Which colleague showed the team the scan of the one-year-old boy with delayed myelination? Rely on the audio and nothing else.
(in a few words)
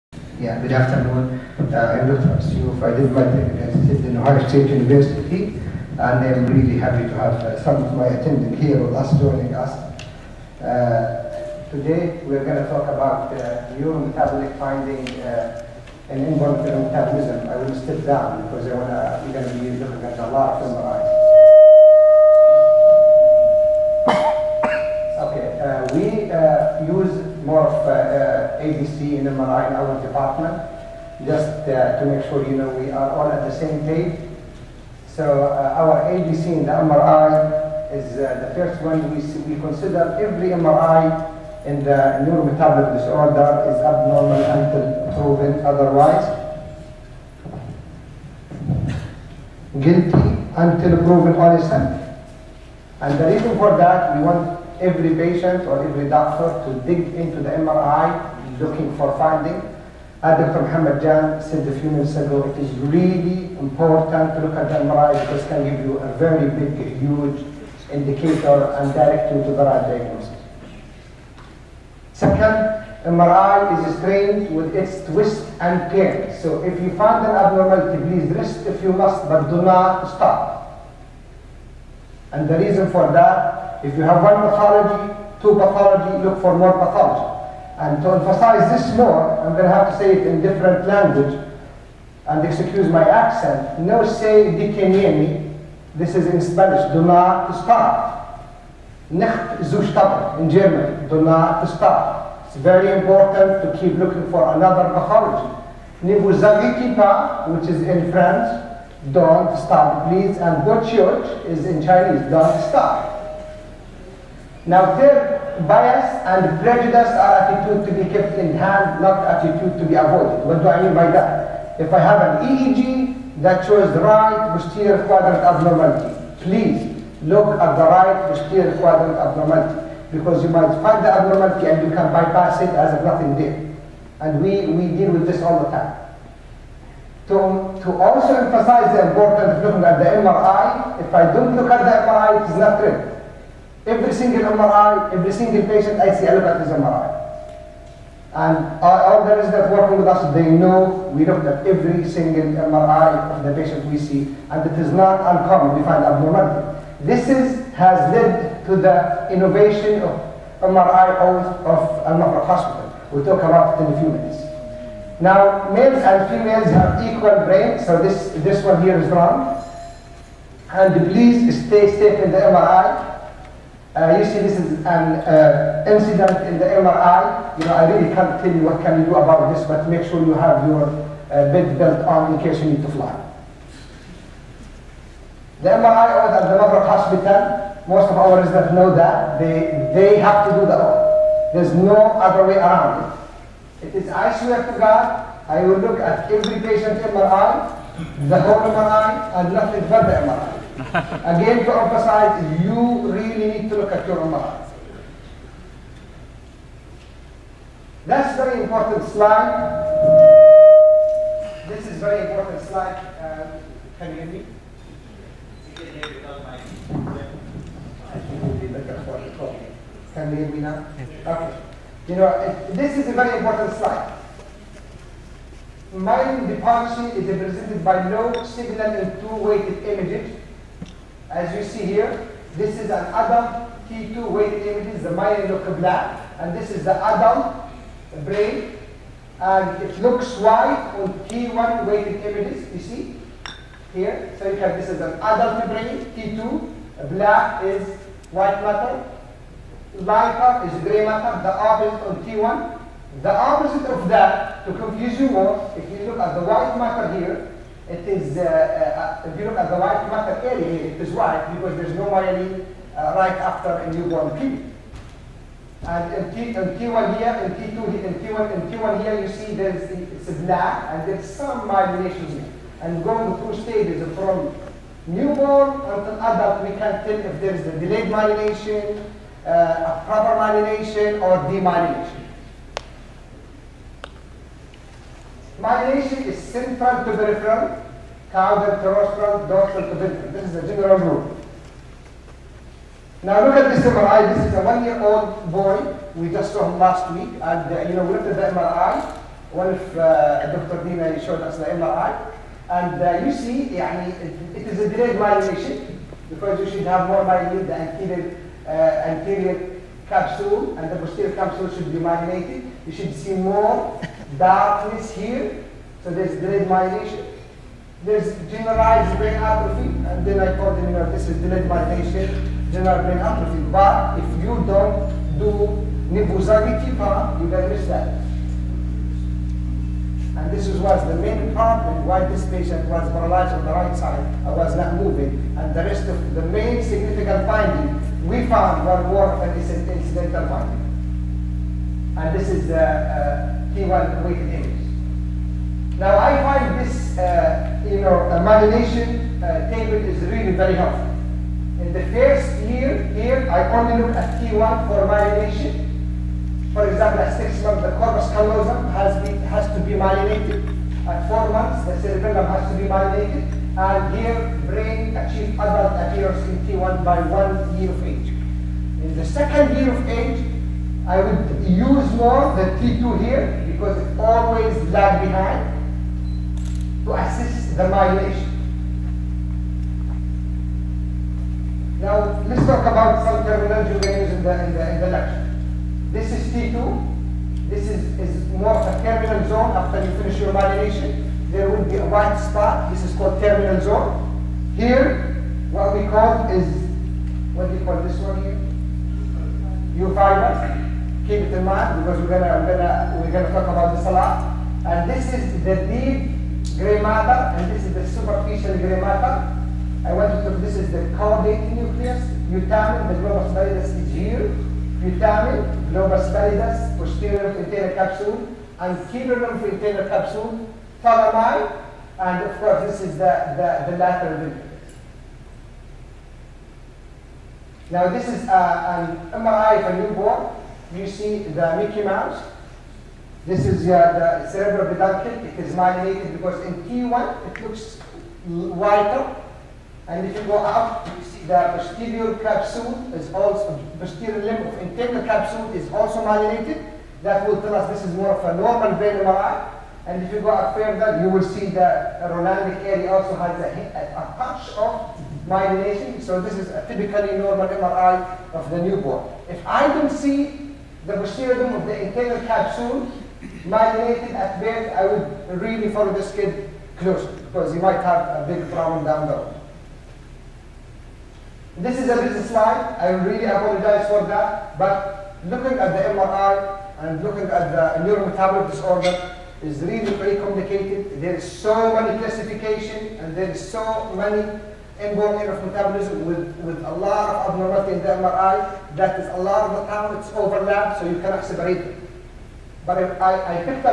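Dr. Dina.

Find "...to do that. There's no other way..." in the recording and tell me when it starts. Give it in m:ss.
3:10.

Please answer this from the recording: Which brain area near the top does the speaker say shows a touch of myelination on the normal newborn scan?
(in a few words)
Rolandic area.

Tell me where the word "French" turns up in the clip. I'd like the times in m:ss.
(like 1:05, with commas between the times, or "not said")
1:48.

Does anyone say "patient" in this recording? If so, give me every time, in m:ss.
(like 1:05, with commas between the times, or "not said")
0:55, 2:25, 2:33, 3:16, 5:32.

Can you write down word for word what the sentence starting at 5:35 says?
And the rest of the main significant finding we found one more of an incidental finding.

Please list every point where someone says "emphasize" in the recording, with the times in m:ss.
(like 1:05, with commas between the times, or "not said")
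1:28, 2:18, 3:21.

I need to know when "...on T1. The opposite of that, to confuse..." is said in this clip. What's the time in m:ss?
4:12.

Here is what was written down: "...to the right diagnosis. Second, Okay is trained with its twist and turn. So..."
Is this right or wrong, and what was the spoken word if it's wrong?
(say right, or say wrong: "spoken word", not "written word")
wrong: "MRI", not "Okay".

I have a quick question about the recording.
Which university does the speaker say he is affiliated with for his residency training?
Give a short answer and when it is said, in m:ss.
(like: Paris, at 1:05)
Ohio State University, at 0:04.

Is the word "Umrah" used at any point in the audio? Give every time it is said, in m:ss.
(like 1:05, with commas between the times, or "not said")
3:24.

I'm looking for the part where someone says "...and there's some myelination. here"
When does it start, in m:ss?
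4:30.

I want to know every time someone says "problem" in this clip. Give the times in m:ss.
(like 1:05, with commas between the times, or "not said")
5:31, 7:48.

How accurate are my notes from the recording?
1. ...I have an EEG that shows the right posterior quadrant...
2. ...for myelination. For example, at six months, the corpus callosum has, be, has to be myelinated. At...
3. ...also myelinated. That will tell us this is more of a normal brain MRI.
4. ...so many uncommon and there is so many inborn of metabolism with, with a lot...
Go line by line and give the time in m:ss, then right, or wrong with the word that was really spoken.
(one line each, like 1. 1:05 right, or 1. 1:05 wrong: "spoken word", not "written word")
1. 2:01 right
2. 5:54 right
3. 7:25 right
4. 8:01 wrong: "classification", not "uncommon".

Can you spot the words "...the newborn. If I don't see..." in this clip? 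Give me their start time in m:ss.
7:38.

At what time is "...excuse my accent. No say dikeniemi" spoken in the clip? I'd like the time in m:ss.
1:32.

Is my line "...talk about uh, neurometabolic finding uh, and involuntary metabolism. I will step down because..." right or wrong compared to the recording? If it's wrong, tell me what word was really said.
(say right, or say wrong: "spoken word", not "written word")
right.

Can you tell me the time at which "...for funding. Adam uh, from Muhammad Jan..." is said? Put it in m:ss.
0:58.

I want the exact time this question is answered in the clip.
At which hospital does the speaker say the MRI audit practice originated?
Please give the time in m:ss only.
2:42.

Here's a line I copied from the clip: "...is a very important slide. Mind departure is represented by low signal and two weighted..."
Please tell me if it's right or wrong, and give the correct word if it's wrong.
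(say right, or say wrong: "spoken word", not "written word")
right.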